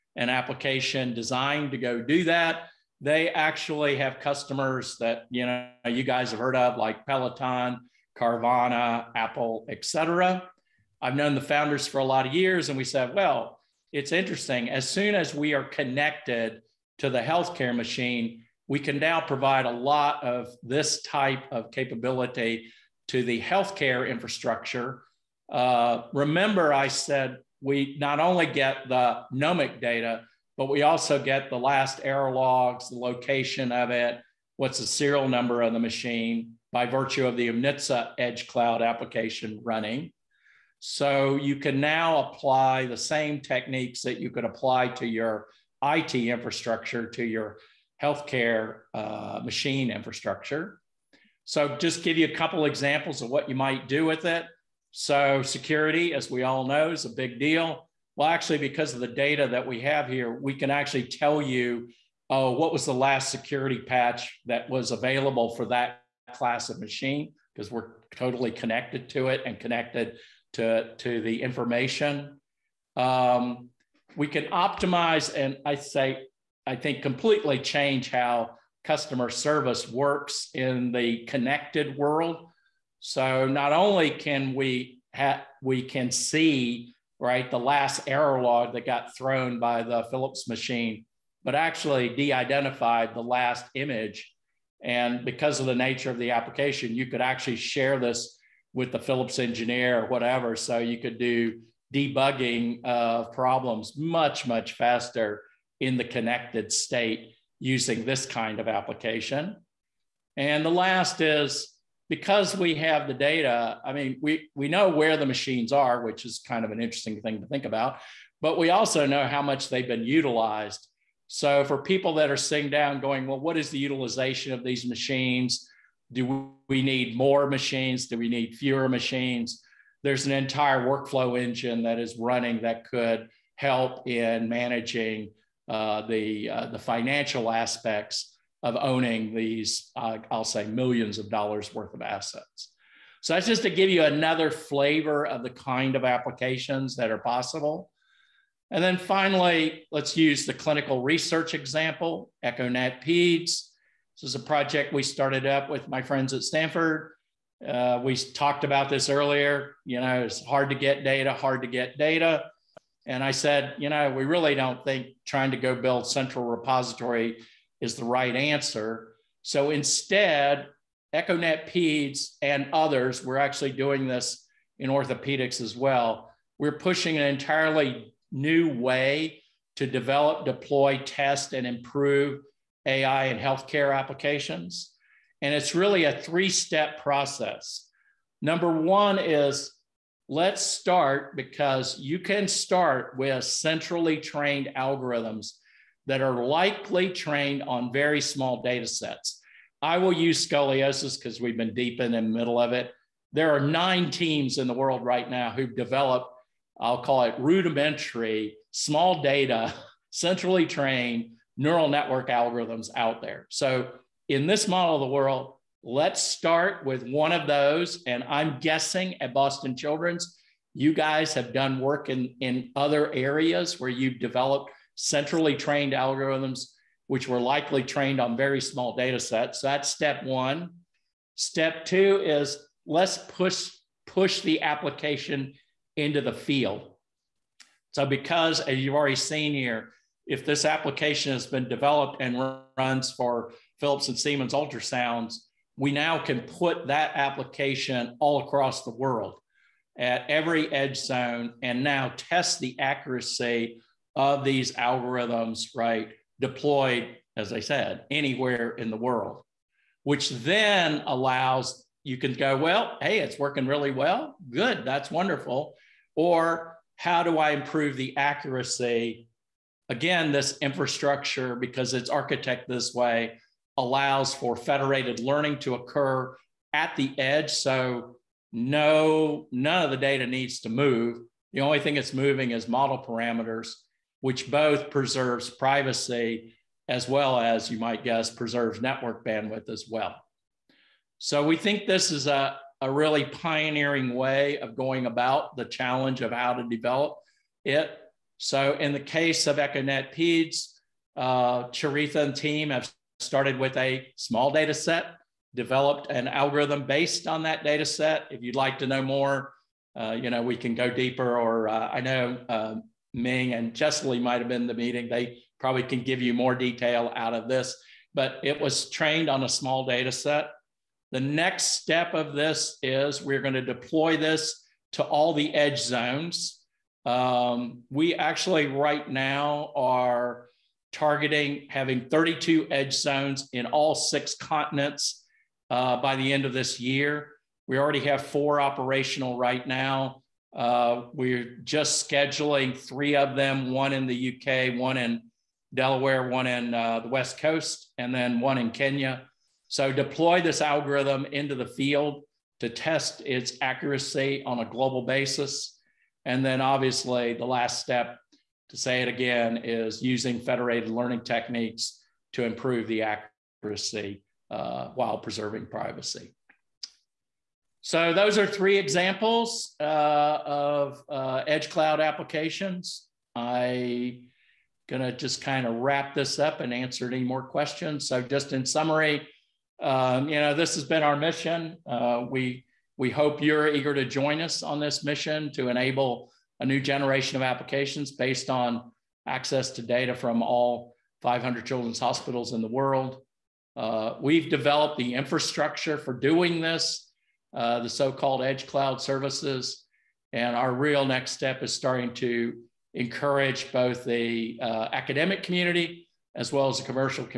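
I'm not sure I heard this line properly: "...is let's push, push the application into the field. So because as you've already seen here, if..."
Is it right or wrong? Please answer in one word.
right.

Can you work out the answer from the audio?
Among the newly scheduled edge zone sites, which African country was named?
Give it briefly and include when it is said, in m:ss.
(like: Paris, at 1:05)
Kenya, at 5:48.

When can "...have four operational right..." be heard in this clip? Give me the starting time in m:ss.
5:38.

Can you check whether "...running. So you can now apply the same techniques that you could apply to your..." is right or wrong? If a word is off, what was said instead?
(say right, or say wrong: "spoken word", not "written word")
right.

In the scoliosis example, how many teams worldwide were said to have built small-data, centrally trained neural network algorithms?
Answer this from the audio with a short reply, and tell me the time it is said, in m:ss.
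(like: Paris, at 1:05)
9, at 3:23.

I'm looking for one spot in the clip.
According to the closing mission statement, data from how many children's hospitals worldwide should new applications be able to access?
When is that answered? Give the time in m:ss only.
6:31.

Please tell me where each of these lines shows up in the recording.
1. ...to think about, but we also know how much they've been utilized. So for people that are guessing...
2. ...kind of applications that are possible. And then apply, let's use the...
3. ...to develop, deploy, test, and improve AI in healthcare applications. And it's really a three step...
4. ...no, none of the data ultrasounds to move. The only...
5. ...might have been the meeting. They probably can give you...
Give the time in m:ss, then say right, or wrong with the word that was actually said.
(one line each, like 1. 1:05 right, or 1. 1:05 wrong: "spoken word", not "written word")
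1. 1:57 wrong: "sitting", not "guessing"
2. 2:25 wrong: "finally", not "apply"
3. 2:59 right
4. 4:38 wrong: "needs", not "ultrasounds"
5. 5:14 right.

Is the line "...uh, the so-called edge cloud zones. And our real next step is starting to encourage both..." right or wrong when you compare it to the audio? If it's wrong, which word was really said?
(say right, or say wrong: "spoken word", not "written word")
wrong: "services", not "zones".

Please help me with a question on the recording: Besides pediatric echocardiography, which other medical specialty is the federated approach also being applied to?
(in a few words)
Orthopedics.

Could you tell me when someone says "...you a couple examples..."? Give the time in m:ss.
0:52.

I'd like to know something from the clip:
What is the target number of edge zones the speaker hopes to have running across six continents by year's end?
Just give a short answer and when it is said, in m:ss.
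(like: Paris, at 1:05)
32, at 5:32.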